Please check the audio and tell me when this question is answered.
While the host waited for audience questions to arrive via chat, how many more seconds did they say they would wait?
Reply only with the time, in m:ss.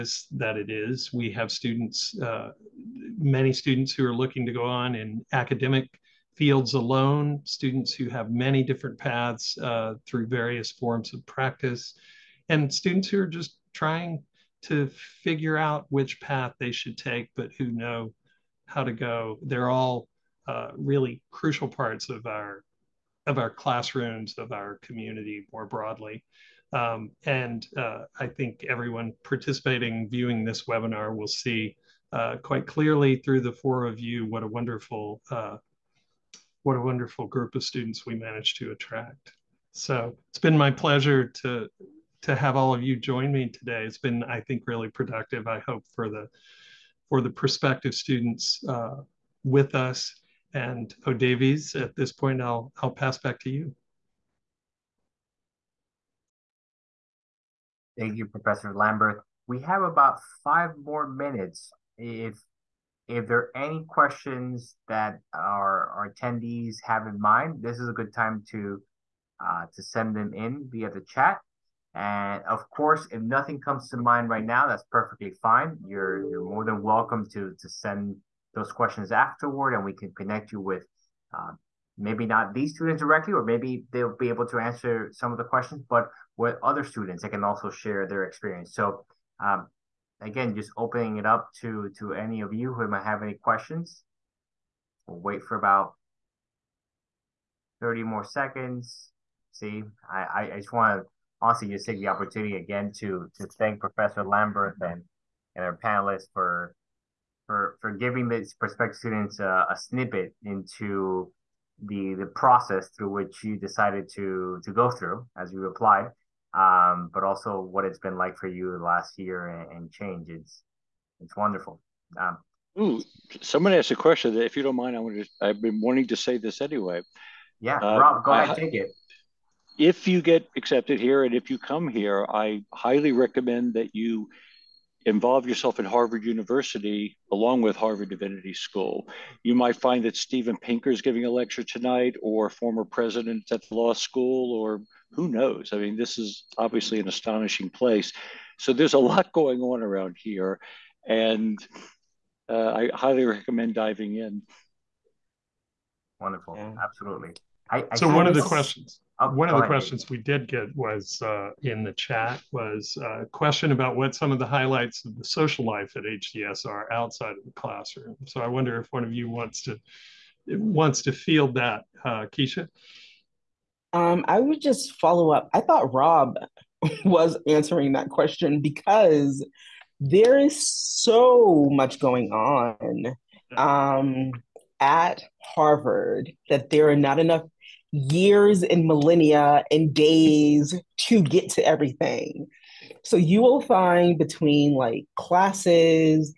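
1:37.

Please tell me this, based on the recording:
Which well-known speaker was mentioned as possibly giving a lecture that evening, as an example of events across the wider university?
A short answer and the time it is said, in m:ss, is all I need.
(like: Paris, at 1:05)
Steven Pinker, at 2:20.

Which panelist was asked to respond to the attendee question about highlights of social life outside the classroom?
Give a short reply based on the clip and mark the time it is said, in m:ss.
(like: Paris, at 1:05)
Keisha, at 2:52.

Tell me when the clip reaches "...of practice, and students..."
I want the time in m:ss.
0:11.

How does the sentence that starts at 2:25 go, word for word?
I mean, this is obviously an astonishing place.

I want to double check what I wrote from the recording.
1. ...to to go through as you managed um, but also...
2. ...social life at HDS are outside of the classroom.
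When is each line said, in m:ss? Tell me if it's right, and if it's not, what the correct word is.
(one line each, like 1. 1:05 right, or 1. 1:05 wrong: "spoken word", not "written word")
1. 1:54 wrong: "applied", not "managed"
2. 2:45 right.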